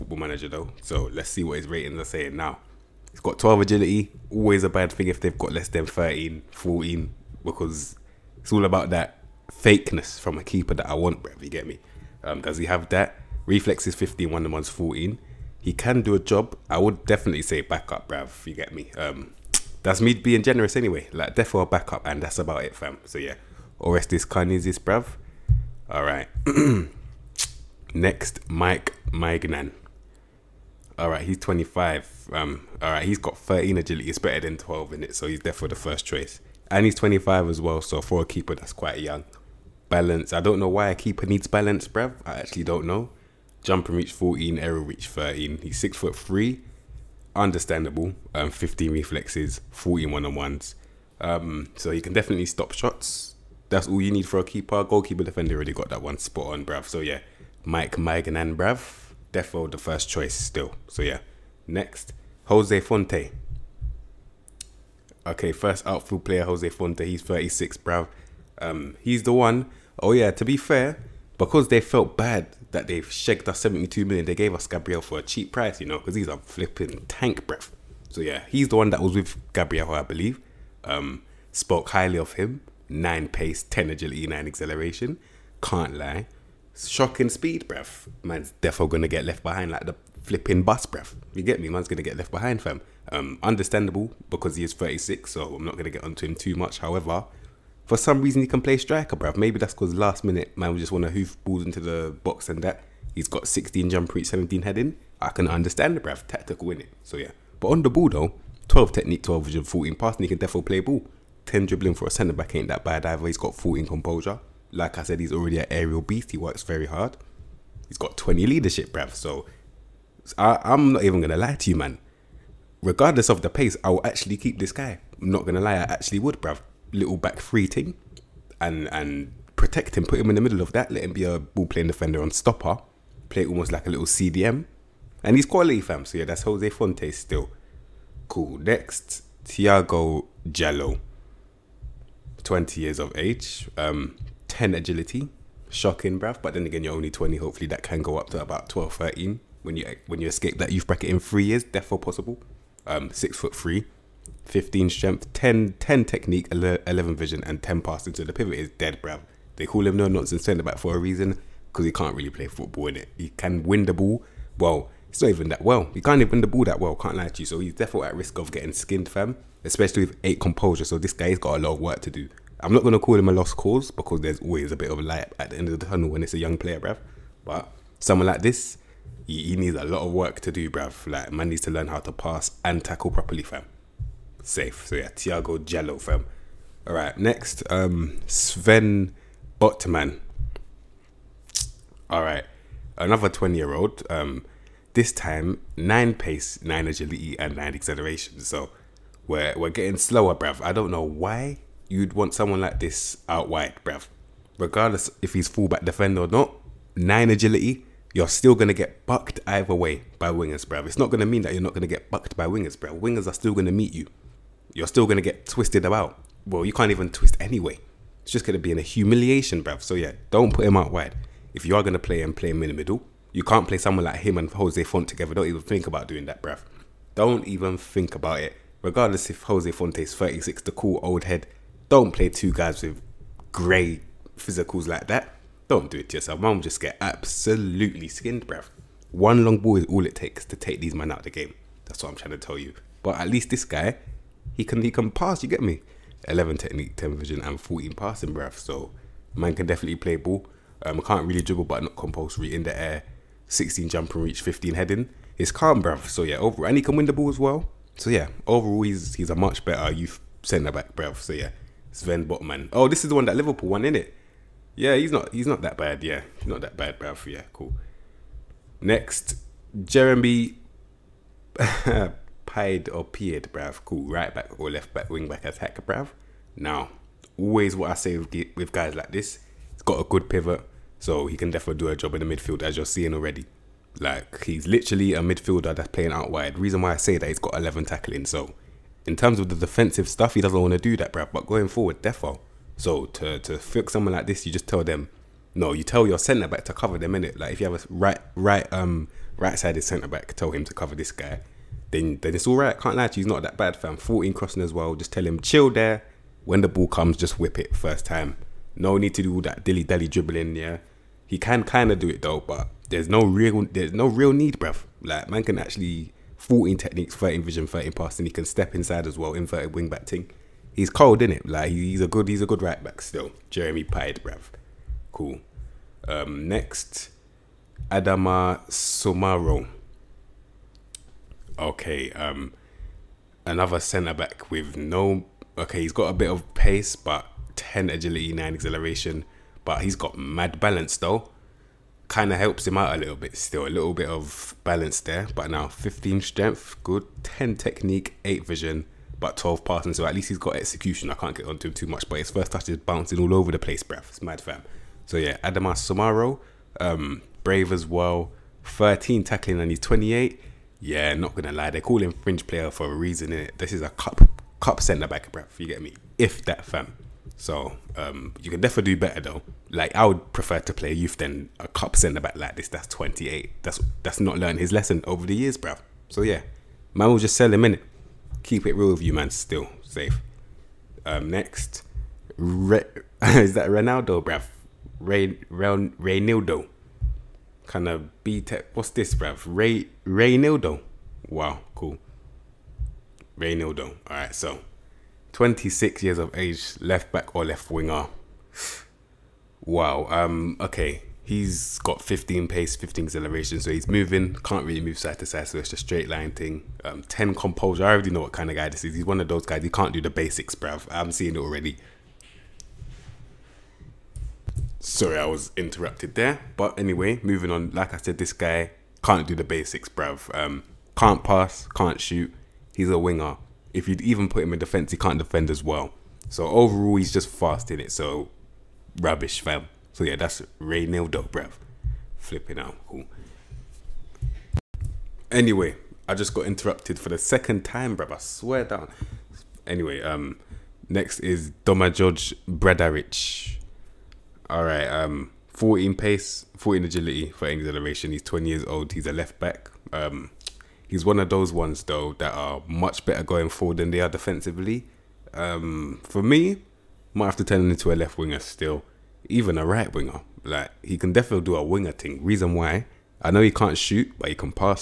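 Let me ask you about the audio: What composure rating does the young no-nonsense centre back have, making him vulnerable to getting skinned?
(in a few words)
8.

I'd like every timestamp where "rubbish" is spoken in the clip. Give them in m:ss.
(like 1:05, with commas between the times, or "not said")
7:08.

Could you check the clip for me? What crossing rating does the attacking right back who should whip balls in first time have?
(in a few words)
14.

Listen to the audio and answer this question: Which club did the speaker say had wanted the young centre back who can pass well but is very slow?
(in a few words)
Liverpool.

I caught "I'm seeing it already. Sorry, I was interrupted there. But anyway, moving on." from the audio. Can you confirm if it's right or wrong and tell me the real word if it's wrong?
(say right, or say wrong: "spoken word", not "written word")
right.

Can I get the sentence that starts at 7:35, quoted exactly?
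Um, for me, might have to turn into a left winger still, even a right winger.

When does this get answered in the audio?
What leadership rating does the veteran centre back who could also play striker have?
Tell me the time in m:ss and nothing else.
1:58.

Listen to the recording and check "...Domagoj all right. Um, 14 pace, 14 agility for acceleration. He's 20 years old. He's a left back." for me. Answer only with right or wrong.
right.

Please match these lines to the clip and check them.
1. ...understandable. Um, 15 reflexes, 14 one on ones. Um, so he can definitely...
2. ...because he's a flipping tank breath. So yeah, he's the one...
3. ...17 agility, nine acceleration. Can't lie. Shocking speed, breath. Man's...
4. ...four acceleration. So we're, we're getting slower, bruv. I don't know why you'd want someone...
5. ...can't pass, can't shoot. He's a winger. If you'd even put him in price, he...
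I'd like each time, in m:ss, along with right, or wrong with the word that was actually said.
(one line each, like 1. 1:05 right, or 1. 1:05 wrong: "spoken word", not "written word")
1. 0:47 right
2. 1:15 right
3. 1:23 wrong: "10", not "17"
4. 3:17 wrong: "nine", not "four"
5. 7:00 wrong: "defence", not "price".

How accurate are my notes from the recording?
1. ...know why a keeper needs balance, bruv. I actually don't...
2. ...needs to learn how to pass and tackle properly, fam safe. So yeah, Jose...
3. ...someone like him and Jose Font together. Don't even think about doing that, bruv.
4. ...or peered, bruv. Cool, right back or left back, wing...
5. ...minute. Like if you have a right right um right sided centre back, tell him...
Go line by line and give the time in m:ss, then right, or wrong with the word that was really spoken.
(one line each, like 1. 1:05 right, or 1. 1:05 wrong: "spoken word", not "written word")
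1. 0:40 right
2. 3:01 wrong: "Tiago", not "Jose"
3. 3:43 right
4. 4:32 right
5. 4:57 right.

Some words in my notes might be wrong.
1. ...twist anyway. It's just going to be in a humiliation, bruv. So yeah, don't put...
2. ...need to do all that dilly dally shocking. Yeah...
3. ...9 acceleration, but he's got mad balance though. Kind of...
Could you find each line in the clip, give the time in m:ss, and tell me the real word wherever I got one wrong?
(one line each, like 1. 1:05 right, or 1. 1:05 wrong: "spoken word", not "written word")
1. 3:37 right
2. 5:08 wrong: "dribbling", not "shocking"
3. 5:38 right.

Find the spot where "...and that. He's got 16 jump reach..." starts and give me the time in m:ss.
1:42.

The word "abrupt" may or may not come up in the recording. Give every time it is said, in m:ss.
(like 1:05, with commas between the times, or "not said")
not said.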